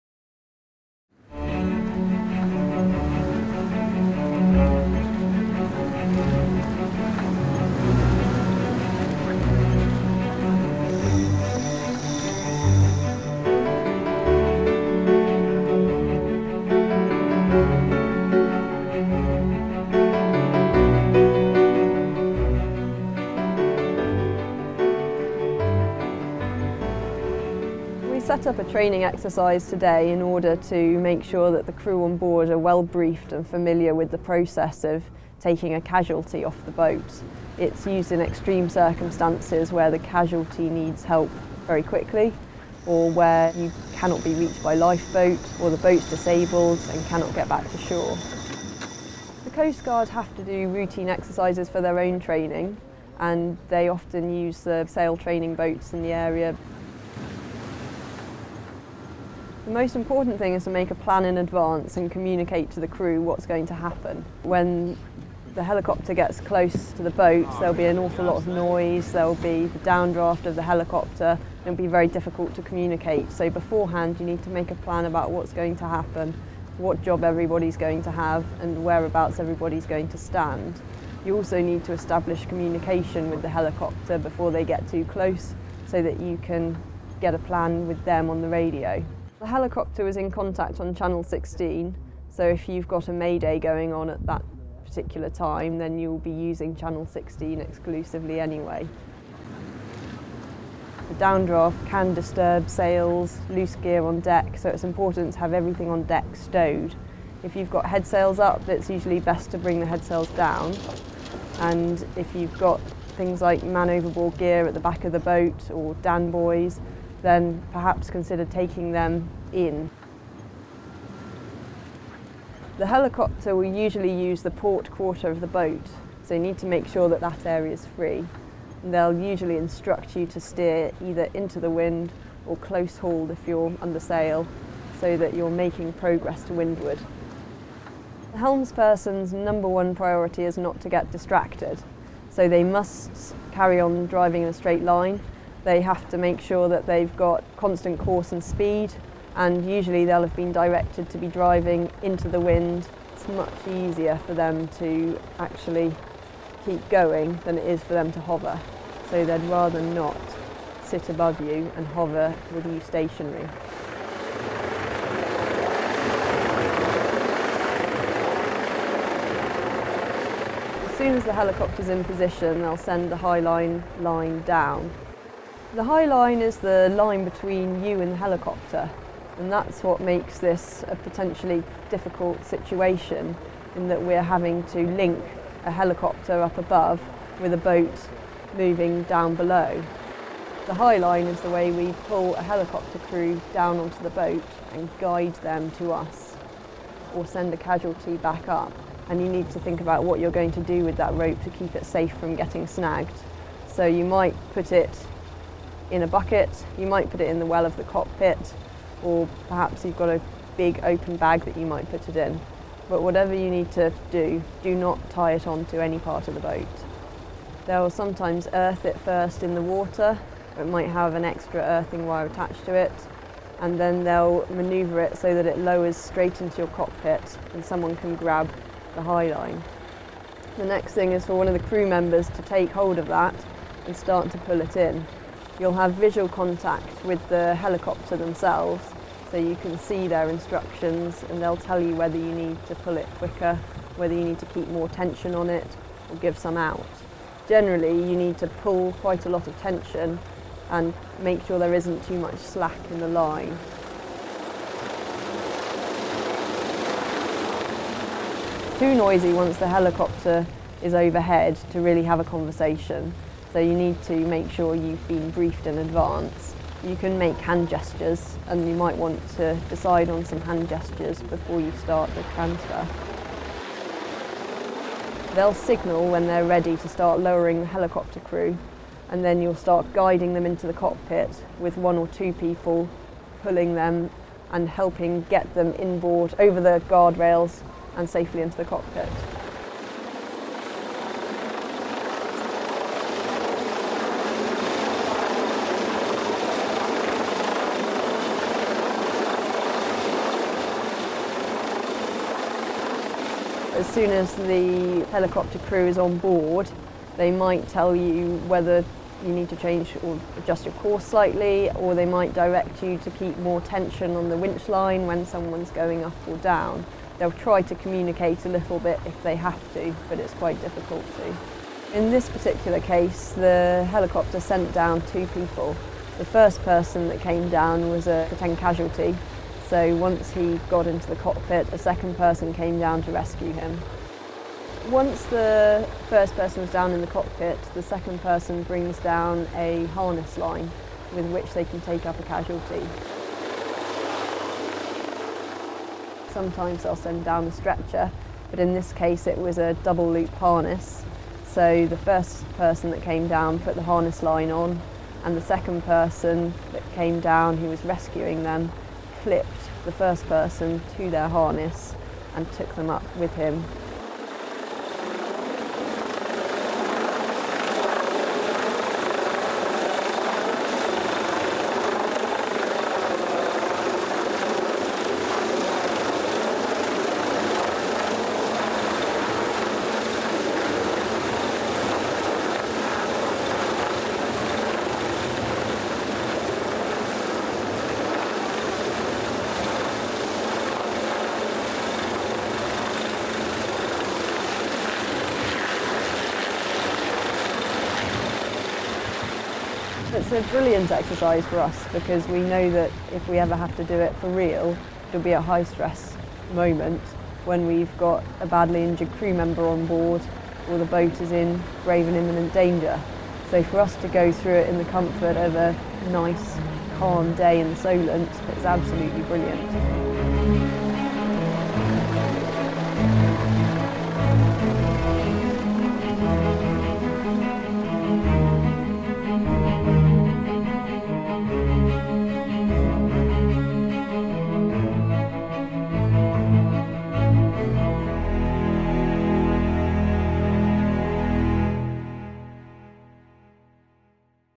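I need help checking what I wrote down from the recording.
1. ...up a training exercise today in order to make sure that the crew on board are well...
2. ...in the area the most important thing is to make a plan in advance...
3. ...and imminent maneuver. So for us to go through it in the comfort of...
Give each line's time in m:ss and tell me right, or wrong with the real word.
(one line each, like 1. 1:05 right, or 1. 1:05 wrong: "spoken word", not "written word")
1. 0:28 right
2. 0:55 right
3. 6:52 wrong: "danger", not "maneuver".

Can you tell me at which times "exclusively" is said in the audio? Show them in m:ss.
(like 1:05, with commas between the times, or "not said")
1:37.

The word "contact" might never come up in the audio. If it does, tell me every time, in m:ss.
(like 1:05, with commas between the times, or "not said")
1:30, 3:56.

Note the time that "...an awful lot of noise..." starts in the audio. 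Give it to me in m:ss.
1:07.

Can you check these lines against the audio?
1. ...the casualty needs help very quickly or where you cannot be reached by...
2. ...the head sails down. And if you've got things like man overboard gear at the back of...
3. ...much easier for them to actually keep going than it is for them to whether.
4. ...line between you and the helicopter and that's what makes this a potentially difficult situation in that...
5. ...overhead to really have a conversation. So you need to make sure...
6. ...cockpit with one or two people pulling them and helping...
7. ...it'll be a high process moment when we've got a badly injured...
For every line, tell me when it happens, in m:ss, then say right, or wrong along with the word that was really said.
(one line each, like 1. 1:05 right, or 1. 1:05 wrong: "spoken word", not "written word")
1. 0:39 right
2. 1:49 right
3. 2:33 wrong: "hover", not "whether"
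4. 2:56 right
5. 4:20 right
6. 4:40 right
7. 6:45 wrong: "stress", not "process".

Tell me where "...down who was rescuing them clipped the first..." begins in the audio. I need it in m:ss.
5:57.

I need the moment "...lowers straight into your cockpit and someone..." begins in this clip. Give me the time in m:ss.
3:45.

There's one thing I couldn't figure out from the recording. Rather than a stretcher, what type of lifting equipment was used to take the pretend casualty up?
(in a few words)
Double loop harness.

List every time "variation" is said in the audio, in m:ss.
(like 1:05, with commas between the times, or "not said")
not said.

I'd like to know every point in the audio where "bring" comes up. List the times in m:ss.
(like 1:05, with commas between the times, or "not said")
1:49, 5:38.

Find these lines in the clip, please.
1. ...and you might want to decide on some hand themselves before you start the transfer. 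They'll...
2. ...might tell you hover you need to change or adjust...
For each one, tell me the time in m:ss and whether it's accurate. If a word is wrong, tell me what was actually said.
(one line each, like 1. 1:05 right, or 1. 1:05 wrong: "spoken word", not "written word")
1. 4:28 wrong: "gestures", not "themselves"
2. 5:07 wrong: "whether", not "hover".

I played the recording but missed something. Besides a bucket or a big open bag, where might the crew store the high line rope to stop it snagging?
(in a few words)
Well of the cockpit.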